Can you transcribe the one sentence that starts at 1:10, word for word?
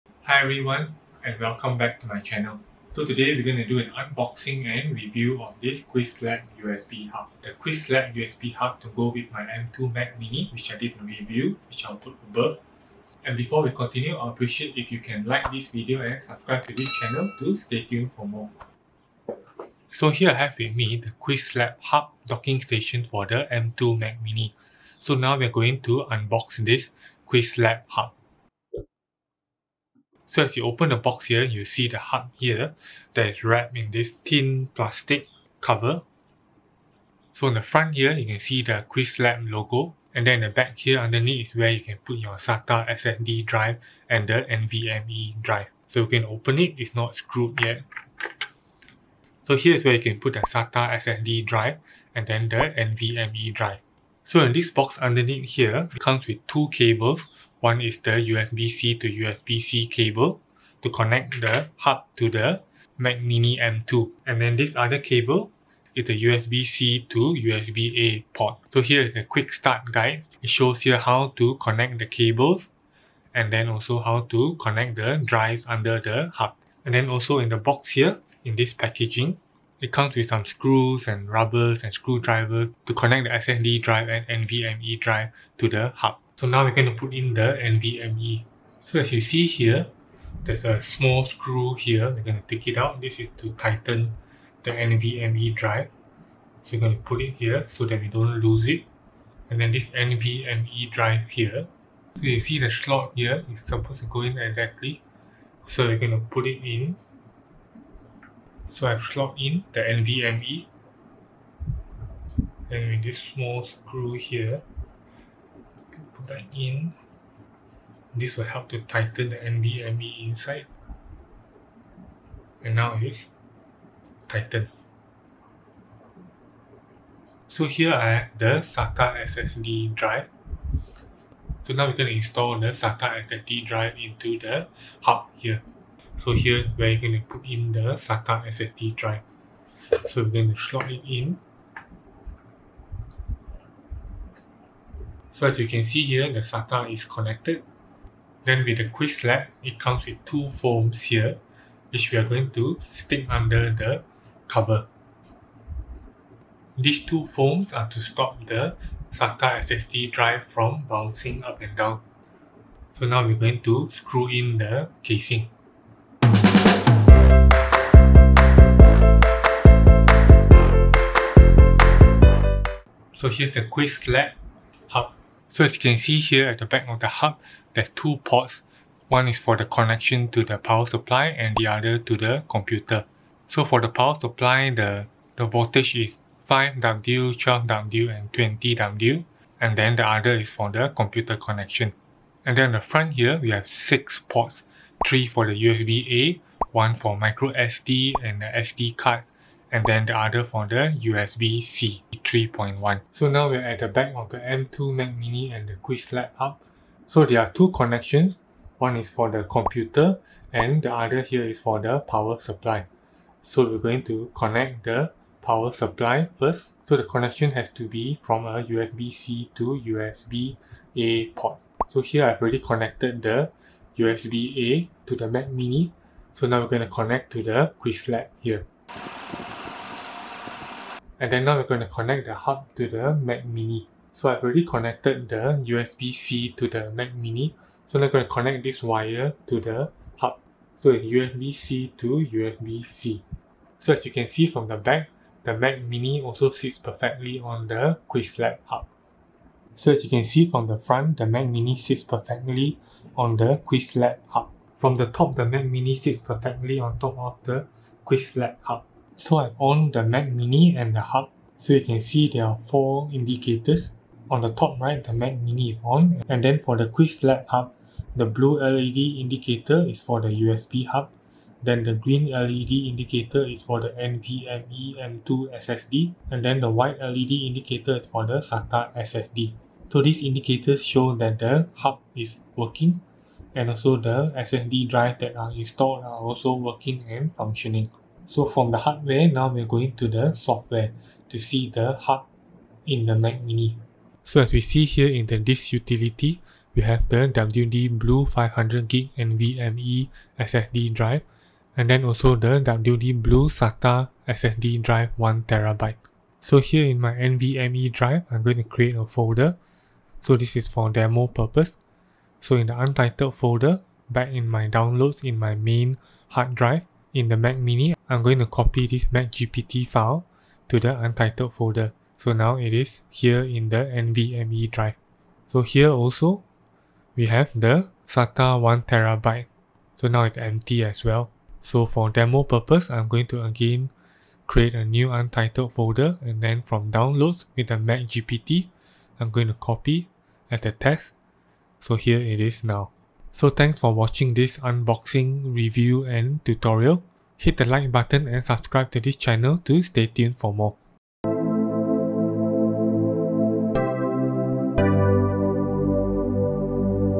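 It shows here how to connect the cables and then also how to connect the drives under the hub.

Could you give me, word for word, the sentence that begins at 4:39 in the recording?
So these indicators show that the hub is working and also the SSD drive that are installed are also working and functioning.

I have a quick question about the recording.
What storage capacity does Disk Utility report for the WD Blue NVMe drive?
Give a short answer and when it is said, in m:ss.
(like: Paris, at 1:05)
500 gig, at 4:58.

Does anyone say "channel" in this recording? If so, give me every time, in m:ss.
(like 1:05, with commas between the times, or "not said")
0:02, 0:16, 5:49.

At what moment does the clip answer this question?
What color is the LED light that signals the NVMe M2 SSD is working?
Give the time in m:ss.
4:31.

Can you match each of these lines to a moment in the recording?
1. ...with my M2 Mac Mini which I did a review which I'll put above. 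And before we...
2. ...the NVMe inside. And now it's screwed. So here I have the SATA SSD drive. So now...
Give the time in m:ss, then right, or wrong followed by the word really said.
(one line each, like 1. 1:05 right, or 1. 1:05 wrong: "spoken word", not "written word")
1. 0:09 right
2. 1:59 wrong: "tightened", not "screwed".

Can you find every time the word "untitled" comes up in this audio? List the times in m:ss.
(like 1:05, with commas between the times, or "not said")
5:12, 5:20, 5:35.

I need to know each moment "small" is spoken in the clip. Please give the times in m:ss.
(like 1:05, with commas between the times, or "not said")
1:30, 1:53.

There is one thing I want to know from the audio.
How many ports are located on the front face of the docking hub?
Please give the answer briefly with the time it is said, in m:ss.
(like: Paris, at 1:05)
6, at 3:13.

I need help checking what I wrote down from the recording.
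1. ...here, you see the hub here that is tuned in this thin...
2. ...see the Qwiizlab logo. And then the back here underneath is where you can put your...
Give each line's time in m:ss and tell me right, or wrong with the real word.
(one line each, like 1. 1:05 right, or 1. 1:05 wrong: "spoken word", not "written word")
1. 0:31 wrong: "wrapped", not "tuned"
2. 0:38 right.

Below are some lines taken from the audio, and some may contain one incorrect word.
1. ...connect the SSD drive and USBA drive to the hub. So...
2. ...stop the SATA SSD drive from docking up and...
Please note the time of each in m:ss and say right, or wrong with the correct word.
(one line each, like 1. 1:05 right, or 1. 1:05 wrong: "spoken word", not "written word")
1. 1:22 wrong: "NVMe", not "USBA"
2. 2:38 wrong: "bouncing", not "docking".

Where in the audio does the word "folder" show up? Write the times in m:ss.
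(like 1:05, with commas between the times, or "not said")
5:09, 5:13, 5:21, 5:35.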